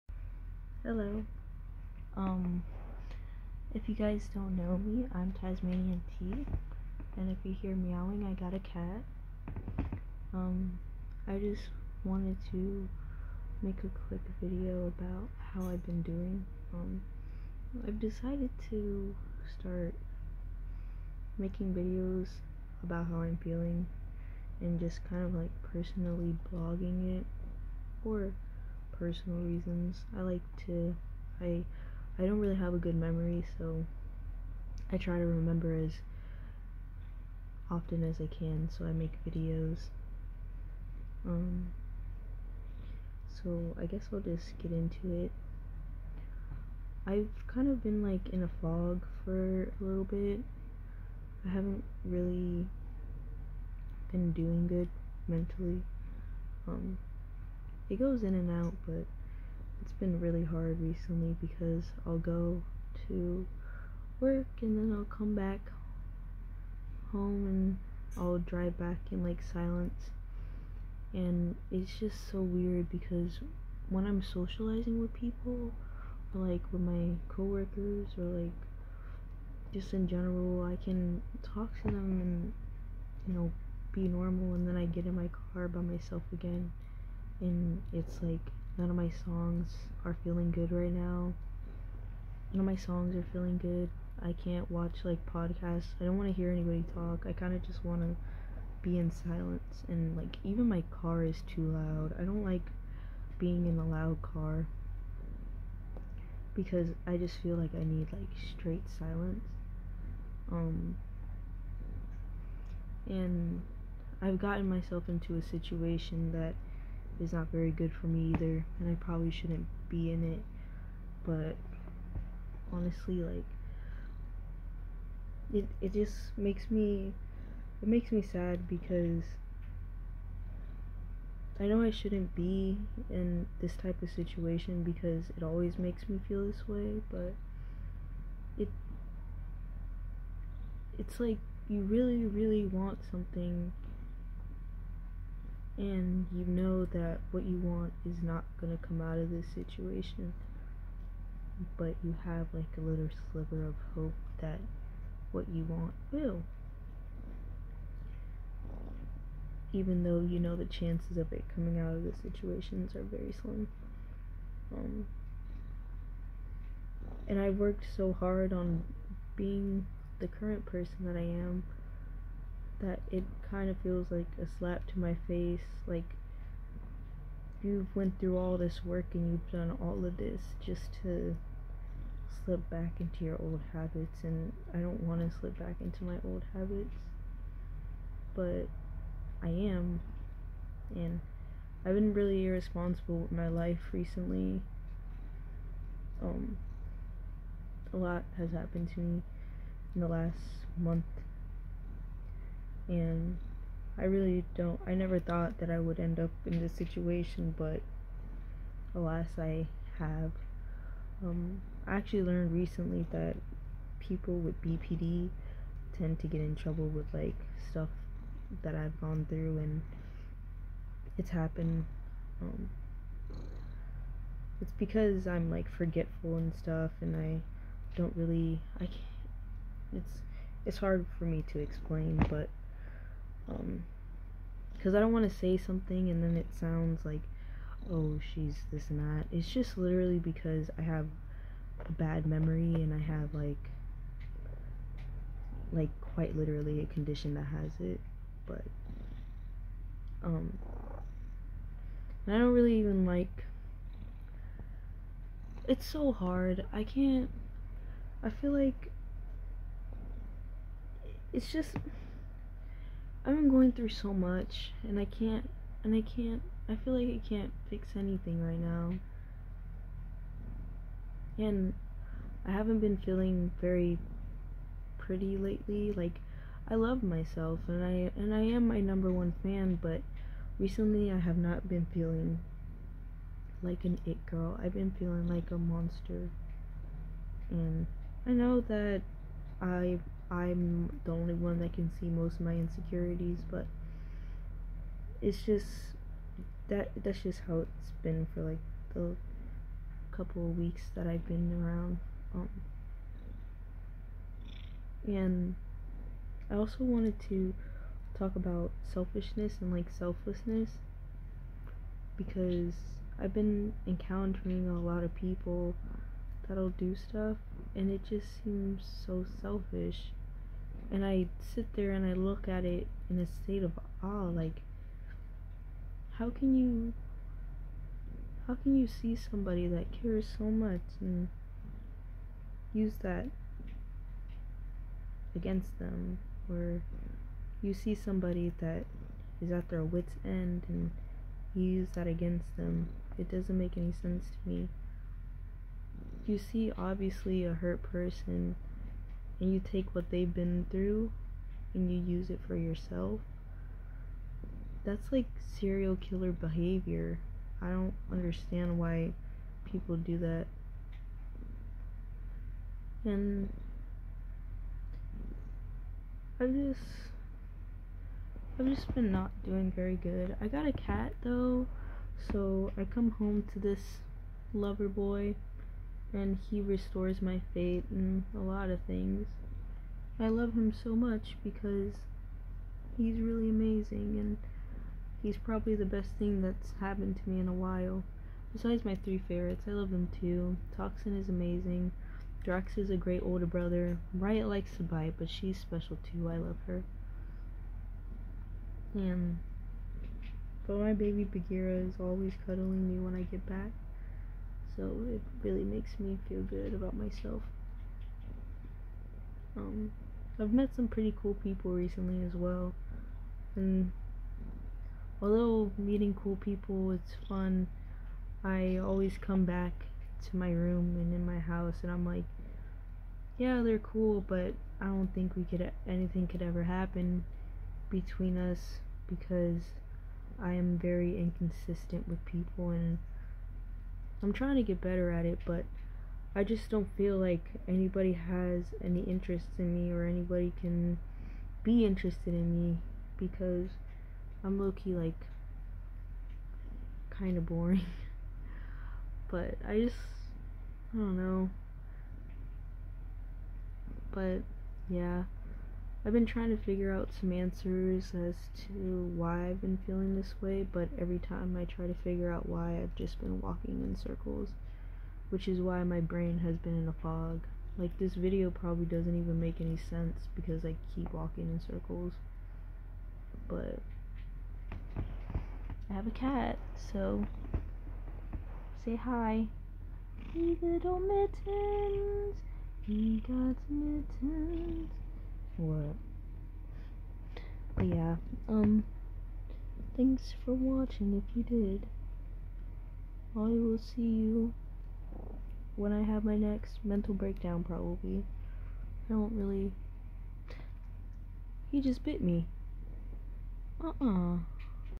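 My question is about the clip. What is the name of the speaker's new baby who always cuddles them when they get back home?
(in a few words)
Bagheera.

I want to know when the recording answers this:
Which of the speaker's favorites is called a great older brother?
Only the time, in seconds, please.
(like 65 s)
392 s.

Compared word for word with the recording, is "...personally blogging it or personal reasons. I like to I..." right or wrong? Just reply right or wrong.
right.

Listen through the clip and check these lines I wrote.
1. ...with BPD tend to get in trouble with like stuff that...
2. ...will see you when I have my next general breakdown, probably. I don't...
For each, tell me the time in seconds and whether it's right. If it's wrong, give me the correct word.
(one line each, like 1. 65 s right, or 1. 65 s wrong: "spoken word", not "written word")
1. 214 s right
2. 493 s wrong: "mental", not "general".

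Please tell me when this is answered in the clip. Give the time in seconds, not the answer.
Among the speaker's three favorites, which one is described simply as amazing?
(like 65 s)
390 s.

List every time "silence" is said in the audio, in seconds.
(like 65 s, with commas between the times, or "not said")
69 s, 99 s, 108 s.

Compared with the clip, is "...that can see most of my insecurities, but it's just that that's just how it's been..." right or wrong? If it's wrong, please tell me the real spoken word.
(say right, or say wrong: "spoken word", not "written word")
right.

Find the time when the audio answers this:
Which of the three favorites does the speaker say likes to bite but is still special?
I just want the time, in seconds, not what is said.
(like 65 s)
394 s.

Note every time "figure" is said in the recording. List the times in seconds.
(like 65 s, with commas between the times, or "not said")
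456 s, 462 s.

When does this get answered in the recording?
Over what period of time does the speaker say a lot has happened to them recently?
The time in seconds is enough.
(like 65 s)
200 s.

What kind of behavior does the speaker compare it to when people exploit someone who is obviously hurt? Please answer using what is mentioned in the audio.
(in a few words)
serial killer behavior.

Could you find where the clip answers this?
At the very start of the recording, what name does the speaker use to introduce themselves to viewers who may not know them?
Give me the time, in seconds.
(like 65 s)
5 s.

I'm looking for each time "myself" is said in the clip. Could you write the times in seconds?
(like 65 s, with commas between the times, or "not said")
85 s, 114 s, 277 s, 406 s.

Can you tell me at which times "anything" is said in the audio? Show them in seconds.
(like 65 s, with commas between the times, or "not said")
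267 s, 425 s.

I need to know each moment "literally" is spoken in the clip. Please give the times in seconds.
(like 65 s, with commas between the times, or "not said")
239 s, 246 s.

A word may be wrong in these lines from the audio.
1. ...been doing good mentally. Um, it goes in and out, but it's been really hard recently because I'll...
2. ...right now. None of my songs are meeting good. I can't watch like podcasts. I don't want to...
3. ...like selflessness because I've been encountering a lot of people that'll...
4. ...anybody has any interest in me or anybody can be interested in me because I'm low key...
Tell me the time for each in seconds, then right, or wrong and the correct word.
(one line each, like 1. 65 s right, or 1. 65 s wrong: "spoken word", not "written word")
1. 54 s right
2. 90 s wrong: "feeling", not "meeting"
3. 309 s right
4. 437 s right.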